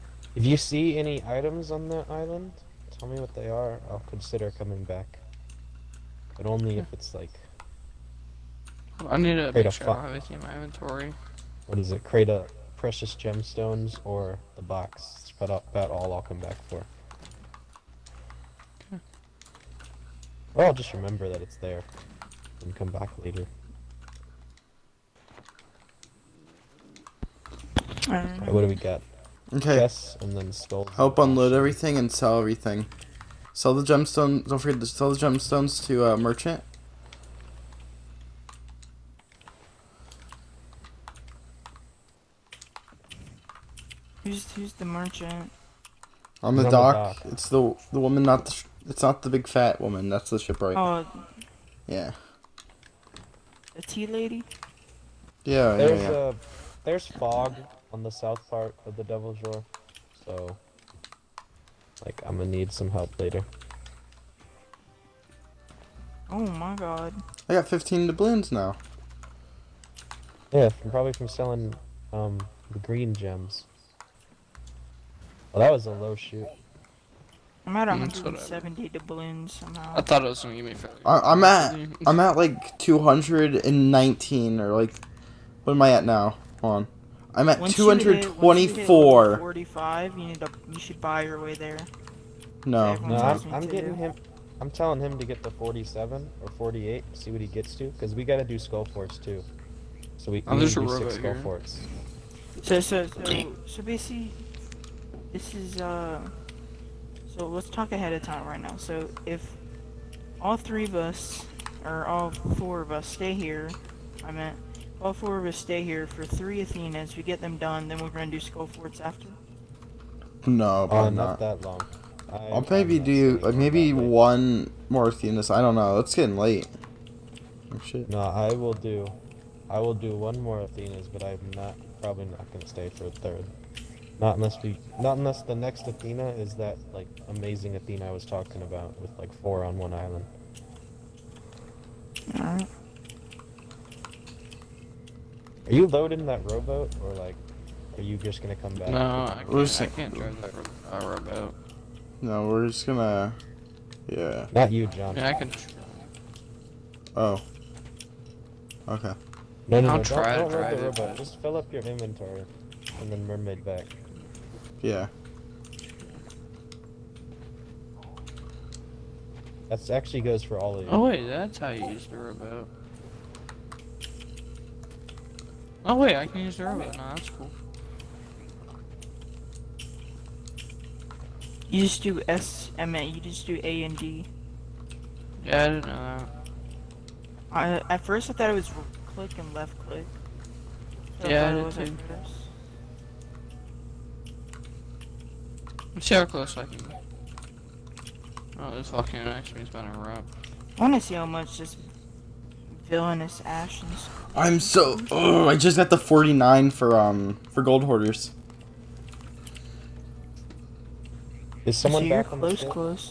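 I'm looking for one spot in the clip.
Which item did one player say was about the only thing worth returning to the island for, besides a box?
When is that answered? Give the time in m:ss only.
0:12.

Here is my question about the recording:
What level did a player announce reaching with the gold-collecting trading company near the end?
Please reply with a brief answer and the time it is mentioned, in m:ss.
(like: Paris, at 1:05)
49, at 3:25.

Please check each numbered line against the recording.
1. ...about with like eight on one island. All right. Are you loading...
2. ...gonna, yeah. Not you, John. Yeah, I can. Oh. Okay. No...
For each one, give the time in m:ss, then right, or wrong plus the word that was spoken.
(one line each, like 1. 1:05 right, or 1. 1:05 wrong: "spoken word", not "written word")
1. 2:18 wrong: "four", not "eight"
2. 2:32 right.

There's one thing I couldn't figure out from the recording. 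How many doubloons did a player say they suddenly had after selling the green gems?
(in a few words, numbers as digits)
15.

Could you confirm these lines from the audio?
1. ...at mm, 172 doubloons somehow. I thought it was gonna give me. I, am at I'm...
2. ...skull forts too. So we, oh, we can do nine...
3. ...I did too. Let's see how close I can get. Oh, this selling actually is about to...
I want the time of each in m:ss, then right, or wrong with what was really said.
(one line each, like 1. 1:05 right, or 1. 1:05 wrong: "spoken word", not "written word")
1. 1:17 wrong: "170", not "172"
2. 1:38 wrong: "six", not "nine"
3. 3:11 wrong: "fucking", not "selling".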